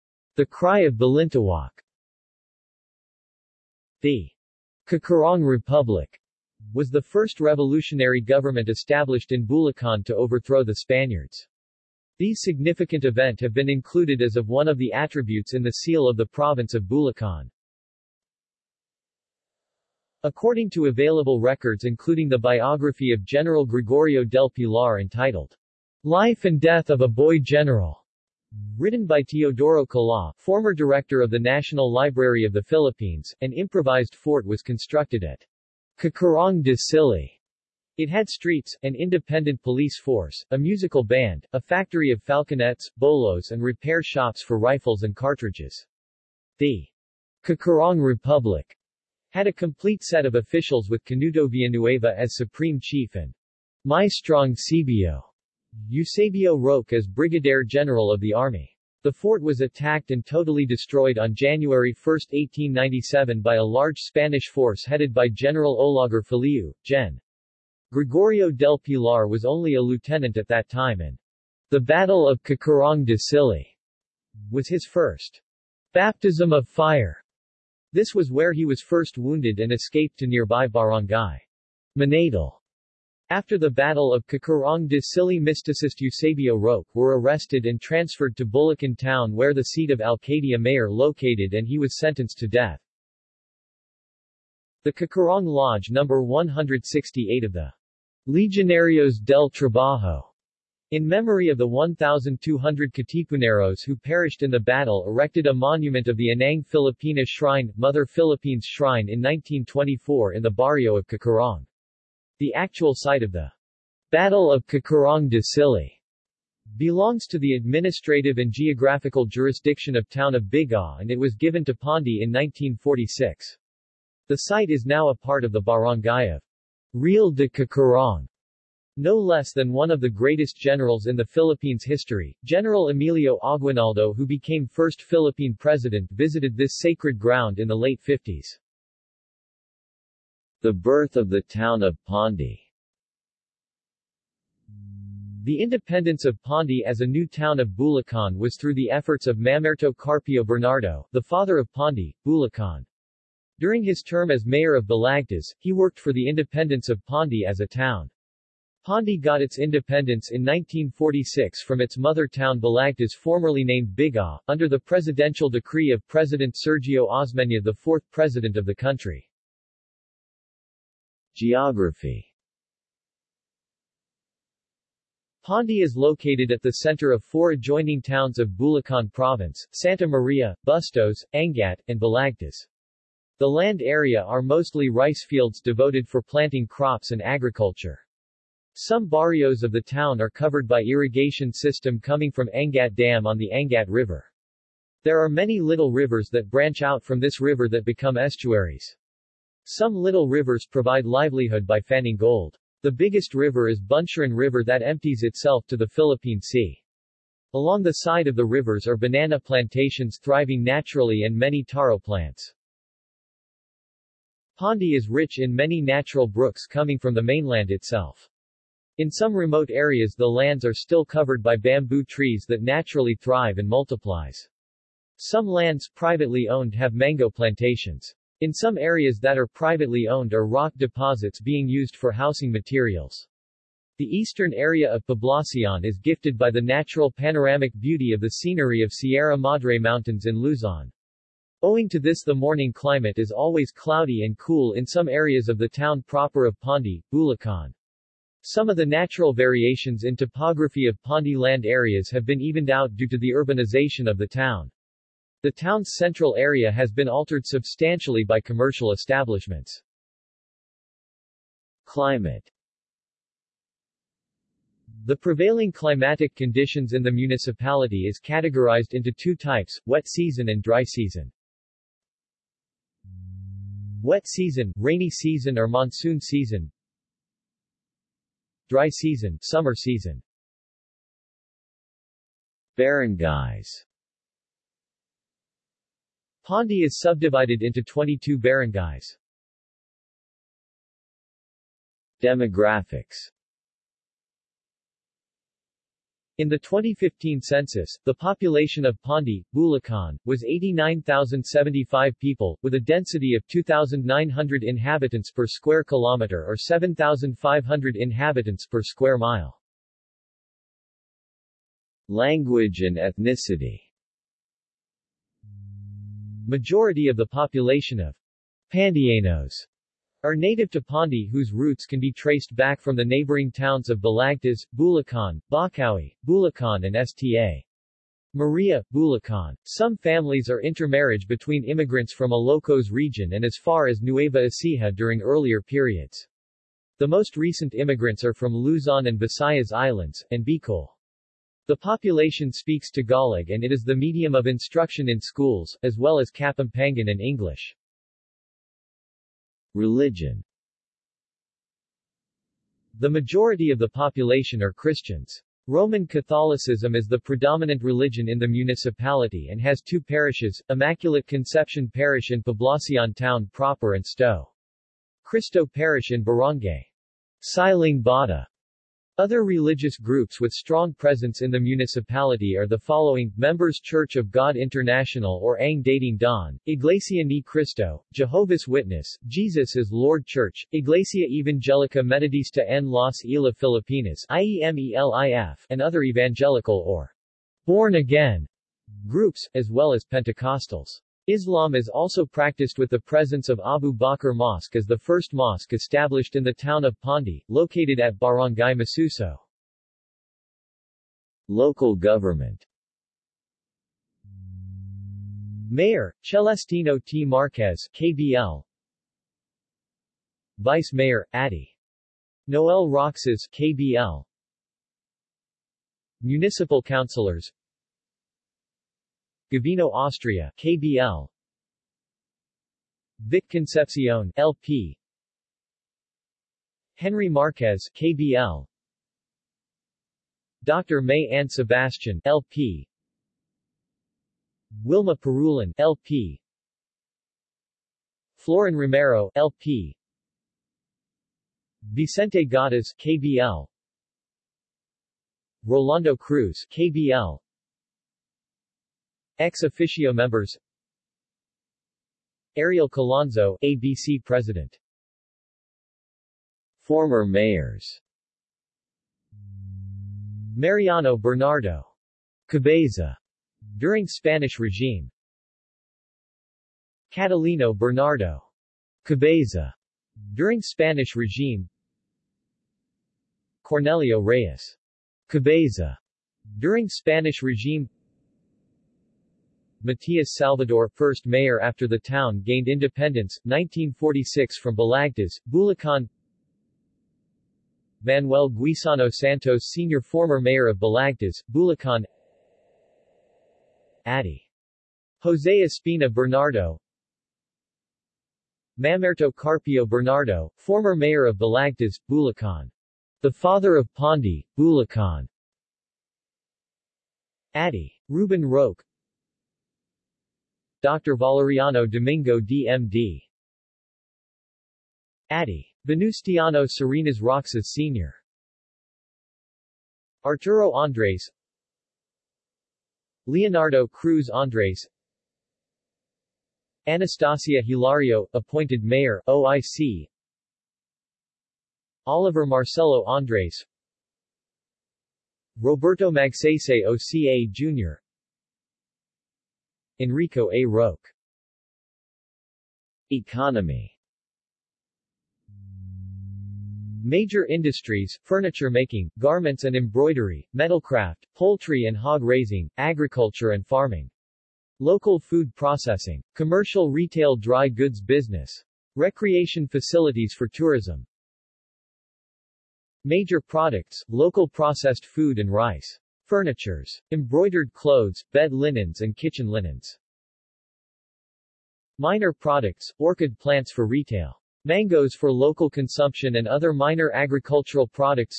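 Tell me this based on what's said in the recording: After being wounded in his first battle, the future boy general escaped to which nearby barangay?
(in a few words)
Manadal.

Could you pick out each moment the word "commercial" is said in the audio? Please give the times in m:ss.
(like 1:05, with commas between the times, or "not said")
4:18, 9:16.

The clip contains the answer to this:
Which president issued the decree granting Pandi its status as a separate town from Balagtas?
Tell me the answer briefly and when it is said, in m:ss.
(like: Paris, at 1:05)
Sergio Osmeña, at 2:46.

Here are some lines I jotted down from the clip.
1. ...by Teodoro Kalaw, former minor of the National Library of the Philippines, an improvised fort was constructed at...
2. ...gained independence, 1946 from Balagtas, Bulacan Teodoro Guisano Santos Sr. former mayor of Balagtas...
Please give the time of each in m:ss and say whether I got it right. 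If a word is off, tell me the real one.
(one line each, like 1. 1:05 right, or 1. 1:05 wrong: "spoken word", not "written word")
1. 0:29 wrong: "director", not "minor"
2. 8:02 wrong: "Manuel", not "Teodoro".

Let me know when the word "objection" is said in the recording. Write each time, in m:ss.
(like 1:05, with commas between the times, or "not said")
not said.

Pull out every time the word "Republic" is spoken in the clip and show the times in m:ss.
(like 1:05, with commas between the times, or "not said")
0:05, 0:48.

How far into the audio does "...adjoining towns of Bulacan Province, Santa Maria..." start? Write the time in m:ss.
2:57.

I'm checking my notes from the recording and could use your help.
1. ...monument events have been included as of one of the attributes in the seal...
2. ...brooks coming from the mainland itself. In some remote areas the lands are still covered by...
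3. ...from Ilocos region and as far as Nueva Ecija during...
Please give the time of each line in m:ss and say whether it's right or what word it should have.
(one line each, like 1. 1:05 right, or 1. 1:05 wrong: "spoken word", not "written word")
1. 0:12 wrong: "significant", not "monument"
2. 3:36 right
3. 5:32 right.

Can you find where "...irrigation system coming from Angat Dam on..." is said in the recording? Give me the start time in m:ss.
3:10.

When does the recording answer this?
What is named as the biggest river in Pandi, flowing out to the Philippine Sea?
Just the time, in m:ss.
3:23.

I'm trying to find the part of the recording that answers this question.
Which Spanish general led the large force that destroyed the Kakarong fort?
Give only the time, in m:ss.
1:05.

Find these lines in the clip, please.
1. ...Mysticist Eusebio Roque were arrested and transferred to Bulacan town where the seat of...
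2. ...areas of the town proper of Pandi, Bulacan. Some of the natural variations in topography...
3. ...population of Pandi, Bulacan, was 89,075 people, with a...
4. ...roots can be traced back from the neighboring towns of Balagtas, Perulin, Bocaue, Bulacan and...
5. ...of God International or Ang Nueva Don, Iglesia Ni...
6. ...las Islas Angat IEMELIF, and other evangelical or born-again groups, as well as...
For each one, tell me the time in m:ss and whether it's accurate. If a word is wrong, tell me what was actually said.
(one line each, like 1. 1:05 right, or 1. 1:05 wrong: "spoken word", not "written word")
1. 1:25 right
2. 4:05 right
3. 4:58 right
4. 5:21 wrong: "Bulacan", not "Perulin"
5. 6:14 wrong: "Dating", not "Nueva"
6. 6:22 wrong: "Filipinas", not "Angat".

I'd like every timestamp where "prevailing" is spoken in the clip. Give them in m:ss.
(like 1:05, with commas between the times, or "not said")
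4:25.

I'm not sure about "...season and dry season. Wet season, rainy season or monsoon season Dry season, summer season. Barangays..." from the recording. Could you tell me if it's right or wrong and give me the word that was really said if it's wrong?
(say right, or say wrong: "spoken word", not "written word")
right.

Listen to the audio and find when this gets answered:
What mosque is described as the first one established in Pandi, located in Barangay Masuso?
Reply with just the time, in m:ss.
6:33.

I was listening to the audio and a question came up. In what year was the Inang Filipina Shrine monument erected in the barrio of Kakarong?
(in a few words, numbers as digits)
1924.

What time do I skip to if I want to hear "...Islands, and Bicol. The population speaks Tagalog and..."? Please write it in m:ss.
5:39.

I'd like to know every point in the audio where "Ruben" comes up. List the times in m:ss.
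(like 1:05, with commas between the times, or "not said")
8:28.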